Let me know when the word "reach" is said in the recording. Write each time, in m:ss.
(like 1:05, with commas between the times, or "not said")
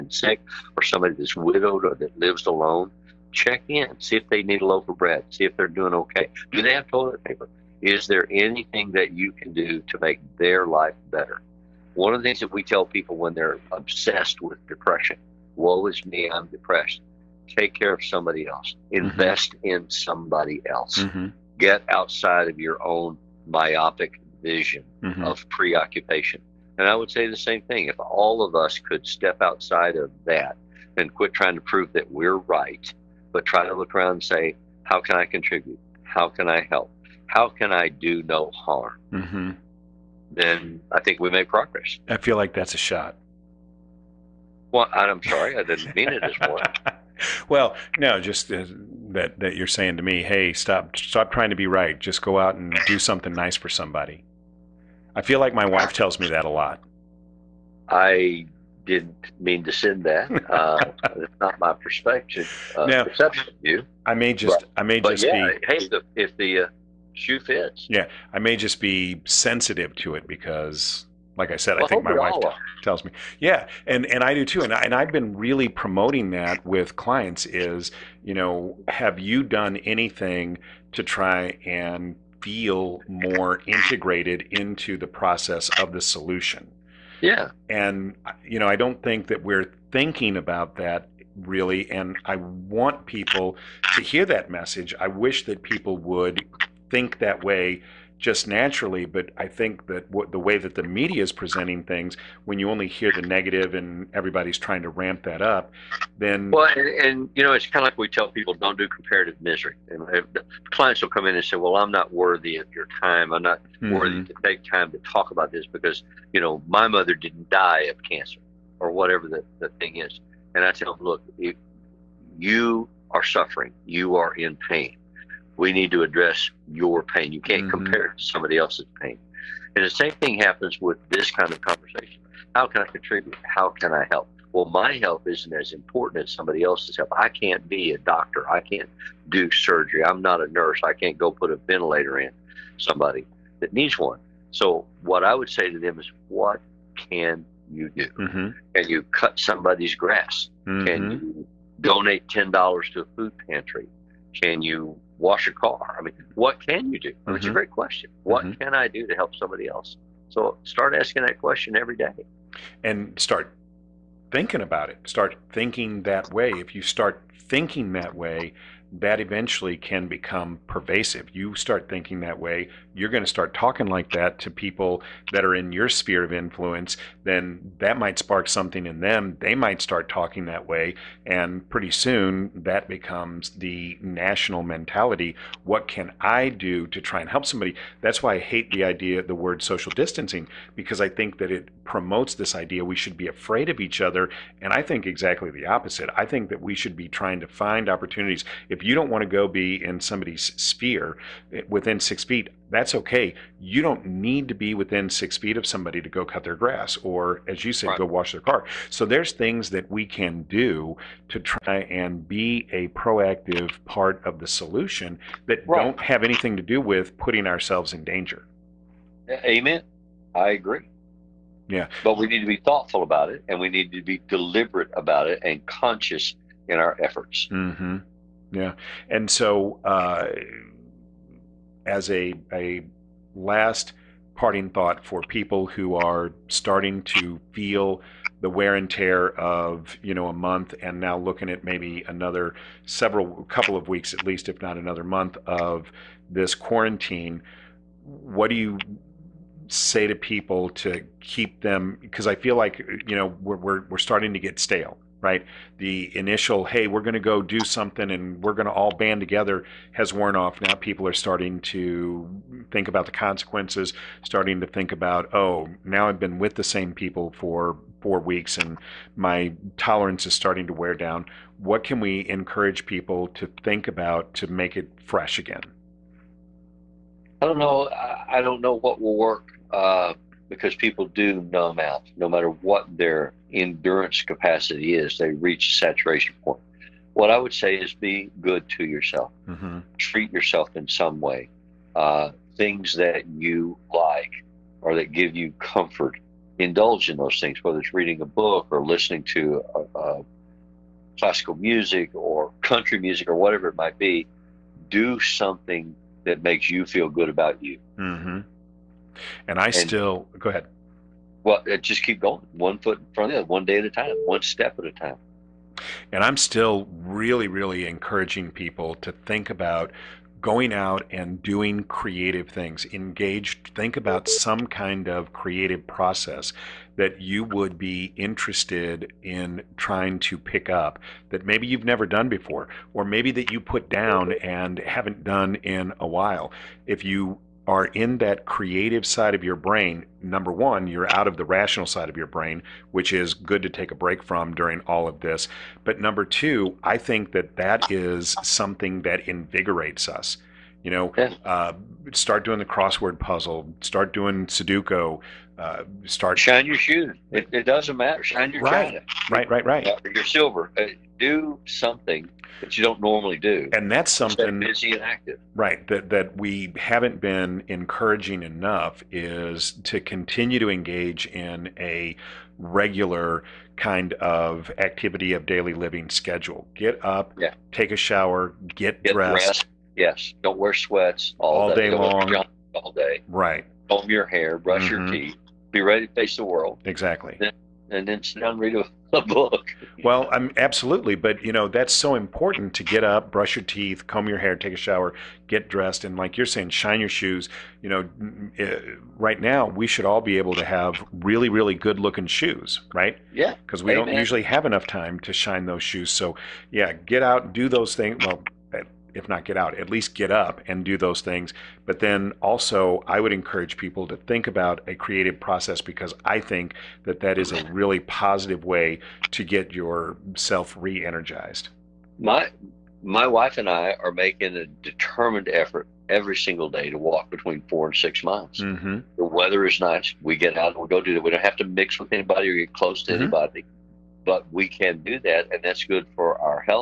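4:45.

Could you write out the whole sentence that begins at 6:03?
And that's something busy and active.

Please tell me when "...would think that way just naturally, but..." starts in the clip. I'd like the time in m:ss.
1:35.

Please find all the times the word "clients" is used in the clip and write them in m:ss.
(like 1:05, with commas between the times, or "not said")
1:16, 1:50.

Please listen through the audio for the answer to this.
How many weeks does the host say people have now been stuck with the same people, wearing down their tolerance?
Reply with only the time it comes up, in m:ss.
4:28.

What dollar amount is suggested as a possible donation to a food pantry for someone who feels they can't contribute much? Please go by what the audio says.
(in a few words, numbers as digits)
$10.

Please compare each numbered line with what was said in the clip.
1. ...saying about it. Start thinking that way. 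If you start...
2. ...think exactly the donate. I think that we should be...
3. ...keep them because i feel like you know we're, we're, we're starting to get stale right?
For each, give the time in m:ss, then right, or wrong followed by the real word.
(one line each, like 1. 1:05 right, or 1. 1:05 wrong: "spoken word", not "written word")
1. 2:44 wrong: "thinking", not "saying"
2. 3:14 wrong: "opposite", not "donate"
3. 4:11 right.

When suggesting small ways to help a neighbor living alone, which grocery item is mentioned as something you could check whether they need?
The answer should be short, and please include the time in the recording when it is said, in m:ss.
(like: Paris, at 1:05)
a loaf of bread, at 0:04.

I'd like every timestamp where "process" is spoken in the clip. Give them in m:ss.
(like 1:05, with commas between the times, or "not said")
1:25, 5:25, 6:55.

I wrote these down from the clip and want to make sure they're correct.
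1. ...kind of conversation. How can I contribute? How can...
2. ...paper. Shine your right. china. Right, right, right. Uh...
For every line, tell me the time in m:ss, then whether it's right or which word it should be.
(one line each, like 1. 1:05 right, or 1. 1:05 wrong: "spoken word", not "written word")
1. 2:11 right
2. 5:57 wrong: "matter", not "paper".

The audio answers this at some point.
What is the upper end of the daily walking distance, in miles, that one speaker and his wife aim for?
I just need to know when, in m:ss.
7:07.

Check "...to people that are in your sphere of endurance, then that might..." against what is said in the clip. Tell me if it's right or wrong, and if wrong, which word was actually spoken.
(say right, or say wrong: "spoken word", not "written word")
wrong: "influence", not "endurance".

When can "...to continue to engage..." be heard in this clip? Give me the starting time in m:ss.
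6:09.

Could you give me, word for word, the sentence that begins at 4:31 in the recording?
What can we encourage people to think about to make it fresh again?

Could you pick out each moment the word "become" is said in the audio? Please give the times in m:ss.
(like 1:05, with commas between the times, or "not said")
2:50, 3:02.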